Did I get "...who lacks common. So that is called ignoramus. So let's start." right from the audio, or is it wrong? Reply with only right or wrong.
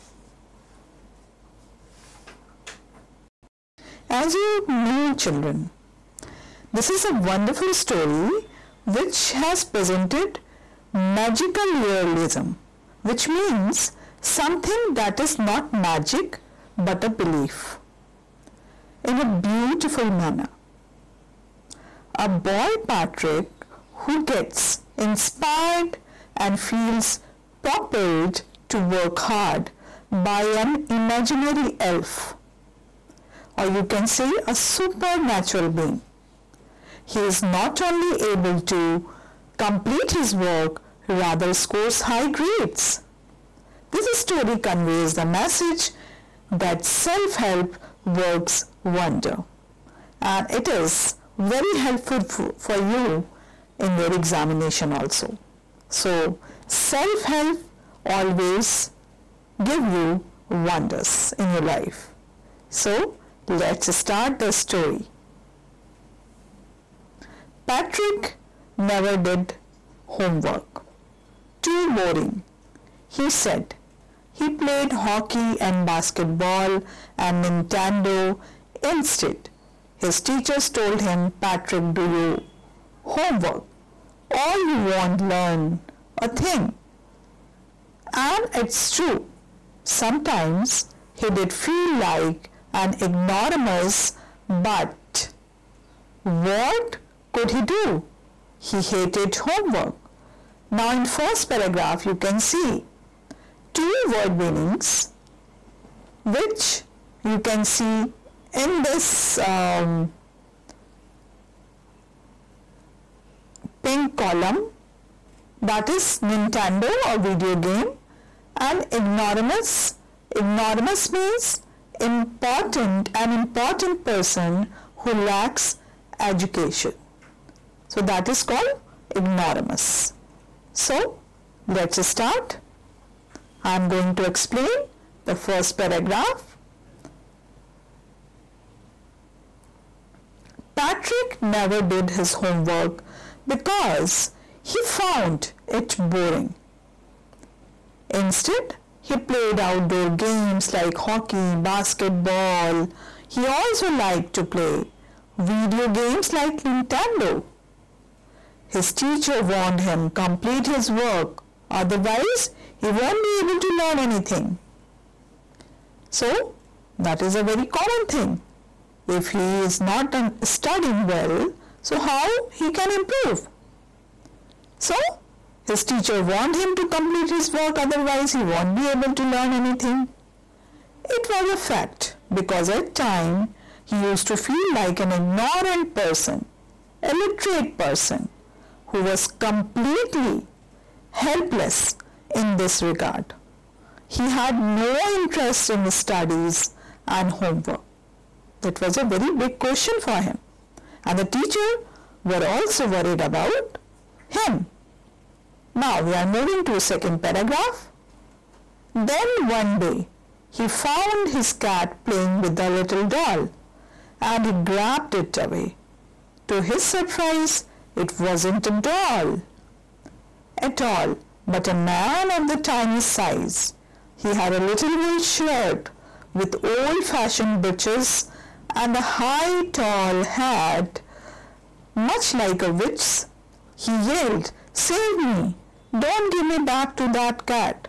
wrong.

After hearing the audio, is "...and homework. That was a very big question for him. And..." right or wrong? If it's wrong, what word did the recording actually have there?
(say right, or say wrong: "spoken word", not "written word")
right.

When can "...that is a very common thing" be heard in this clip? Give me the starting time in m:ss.
2:46.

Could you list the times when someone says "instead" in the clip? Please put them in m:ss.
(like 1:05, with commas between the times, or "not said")
1:18, 2:28.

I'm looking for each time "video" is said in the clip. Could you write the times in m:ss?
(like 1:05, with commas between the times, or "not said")
1:57, 2:35.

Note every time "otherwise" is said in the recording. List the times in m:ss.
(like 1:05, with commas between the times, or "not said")
2:41, 2:57.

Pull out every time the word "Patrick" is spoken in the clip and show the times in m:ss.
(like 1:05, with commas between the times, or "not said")
0:22, 1:07, 1:21, 2:20.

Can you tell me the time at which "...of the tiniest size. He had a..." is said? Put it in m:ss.
3:42.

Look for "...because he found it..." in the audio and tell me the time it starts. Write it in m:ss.
2:23.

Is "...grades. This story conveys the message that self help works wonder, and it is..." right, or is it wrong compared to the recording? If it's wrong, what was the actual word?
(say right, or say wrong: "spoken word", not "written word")
right.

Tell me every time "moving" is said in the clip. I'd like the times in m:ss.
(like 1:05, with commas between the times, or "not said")
3:26.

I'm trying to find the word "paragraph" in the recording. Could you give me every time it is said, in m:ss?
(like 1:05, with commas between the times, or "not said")
1:41, 2:15, 3:27.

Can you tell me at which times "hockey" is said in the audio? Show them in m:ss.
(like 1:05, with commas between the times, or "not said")
1:14, 2:31.